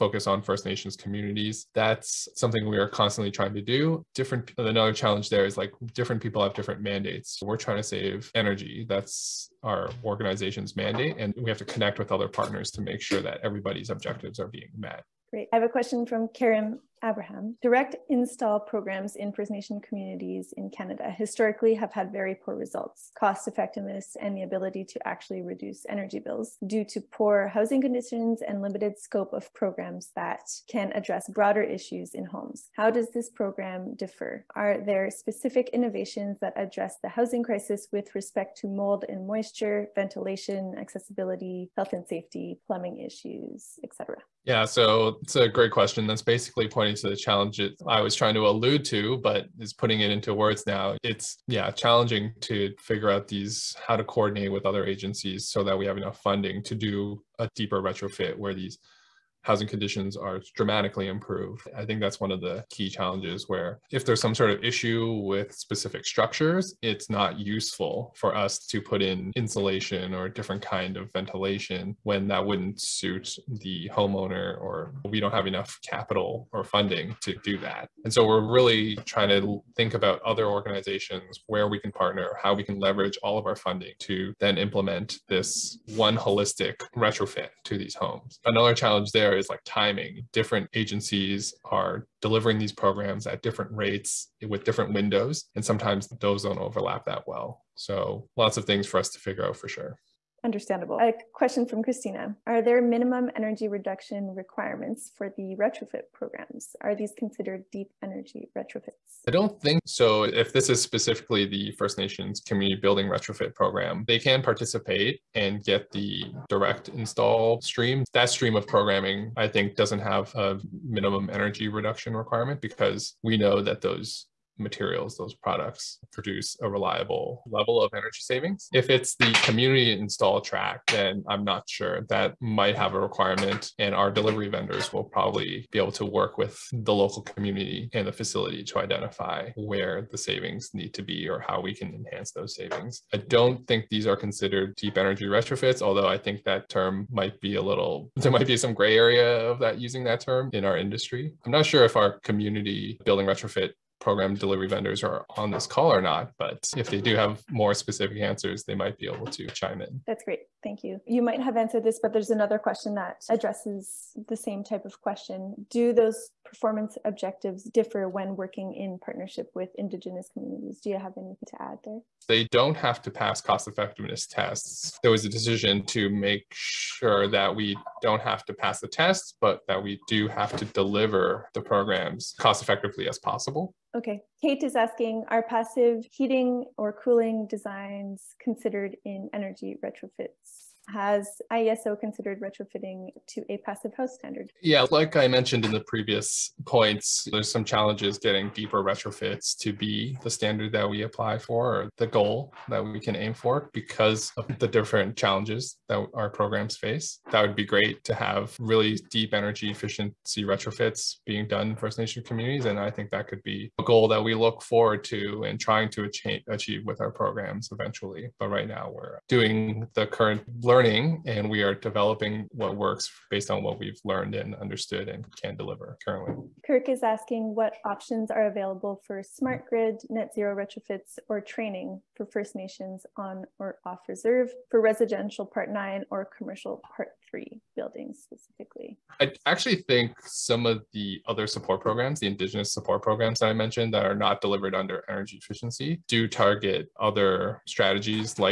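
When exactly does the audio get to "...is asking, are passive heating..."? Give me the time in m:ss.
3:04.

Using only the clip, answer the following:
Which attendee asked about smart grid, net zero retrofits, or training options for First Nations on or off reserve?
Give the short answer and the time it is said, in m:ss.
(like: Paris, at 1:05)
Kirk, at 3:46.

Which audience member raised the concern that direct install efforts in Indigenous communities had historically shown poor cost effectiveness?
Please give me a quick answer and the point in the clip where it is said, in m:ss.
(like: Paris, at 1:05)
Karen Abraham, at 0:16.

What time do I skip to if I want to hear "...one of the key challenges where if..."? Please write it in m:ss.
1:02.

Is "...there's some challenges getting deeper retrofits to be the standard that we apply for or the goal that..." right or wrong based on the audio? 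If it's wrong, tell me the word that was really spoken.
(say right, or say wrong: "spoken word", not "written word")
right.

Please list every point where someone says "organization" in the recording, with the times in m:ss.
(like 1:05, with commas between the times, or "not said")
0:10, 1:20.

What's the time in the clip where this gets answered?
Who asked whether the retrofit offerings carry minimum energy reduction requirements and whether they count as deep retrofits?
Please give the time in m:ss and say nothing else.
1:41.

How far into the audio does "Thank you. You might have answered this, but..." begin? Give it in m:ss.
2:40.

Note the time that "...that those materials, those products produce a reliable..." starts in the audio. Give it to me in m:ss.
2:03.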